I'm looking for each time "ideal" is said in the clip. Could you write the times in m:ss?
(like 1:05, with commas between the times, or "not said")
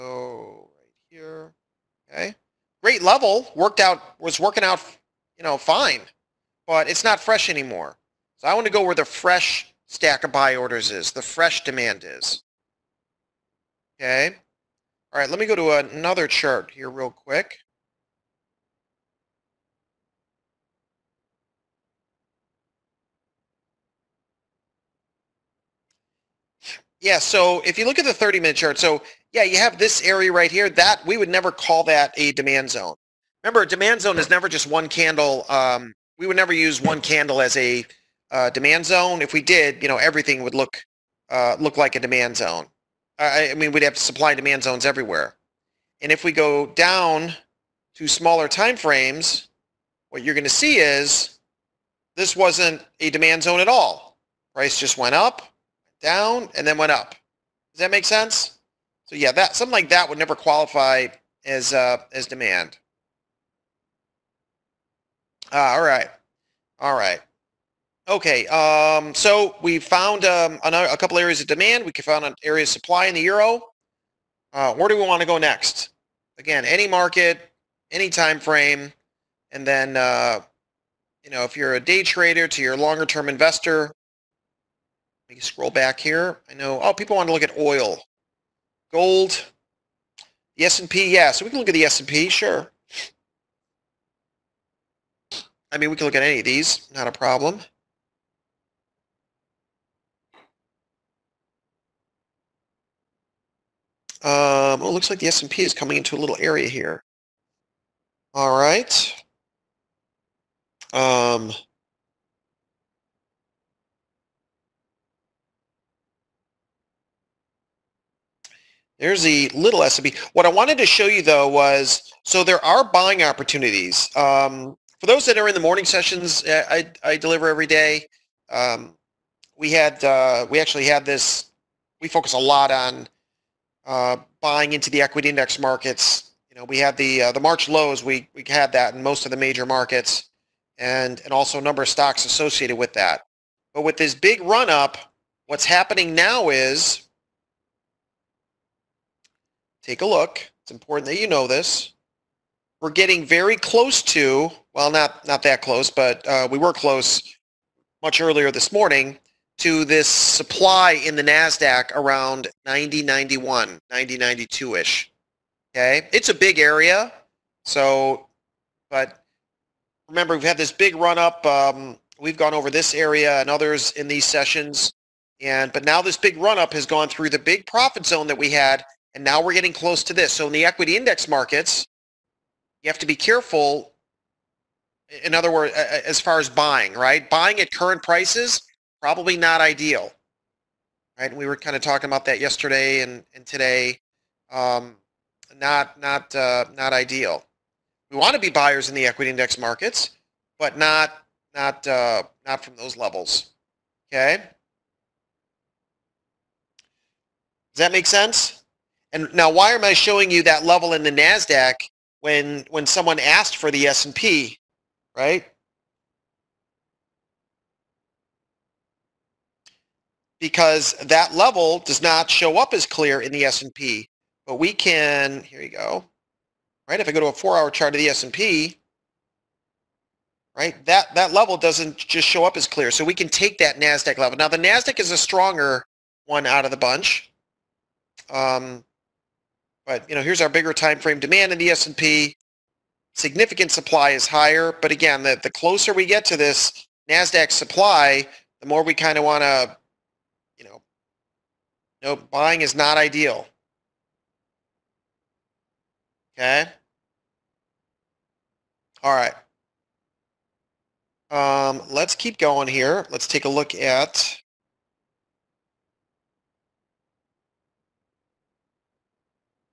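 3:09, 3:16, 4:12.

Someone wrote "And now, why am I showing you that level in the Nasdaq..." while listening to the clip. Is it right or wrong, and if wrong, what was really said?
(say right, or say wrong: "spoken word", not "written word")
right.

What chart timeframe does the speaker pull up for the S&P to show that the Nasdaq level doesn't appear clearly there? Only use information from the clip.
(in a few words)
four-hour.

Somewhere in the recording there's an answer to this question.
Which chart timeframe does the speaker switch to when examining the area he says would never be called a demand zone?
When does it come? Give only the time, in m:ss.
0:28.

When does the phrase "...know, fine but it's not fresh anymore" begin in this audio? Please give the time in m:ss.
0:05.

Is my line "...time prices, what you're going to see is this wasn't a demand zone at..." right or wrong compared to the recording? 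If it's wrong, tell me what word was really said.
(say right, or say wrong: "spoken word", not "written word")
wrong: "frames", not "prices".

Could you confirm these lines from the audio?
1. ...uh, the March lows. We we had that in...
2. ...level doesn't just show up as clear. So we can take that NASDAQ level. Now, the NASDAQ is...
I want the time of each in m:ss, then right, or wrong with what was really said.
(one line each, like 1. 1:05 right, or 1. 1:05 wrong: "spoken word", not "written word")
1. 2:17 right
2. 3:51 right.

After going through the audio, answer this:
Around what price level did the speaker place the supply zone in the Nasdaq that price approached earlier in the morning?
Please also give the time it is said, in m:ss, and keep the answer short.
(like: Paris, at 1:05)
9091, at 2:42.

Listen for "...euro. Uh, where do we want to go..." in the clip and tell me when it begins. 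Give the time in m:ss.
1:13.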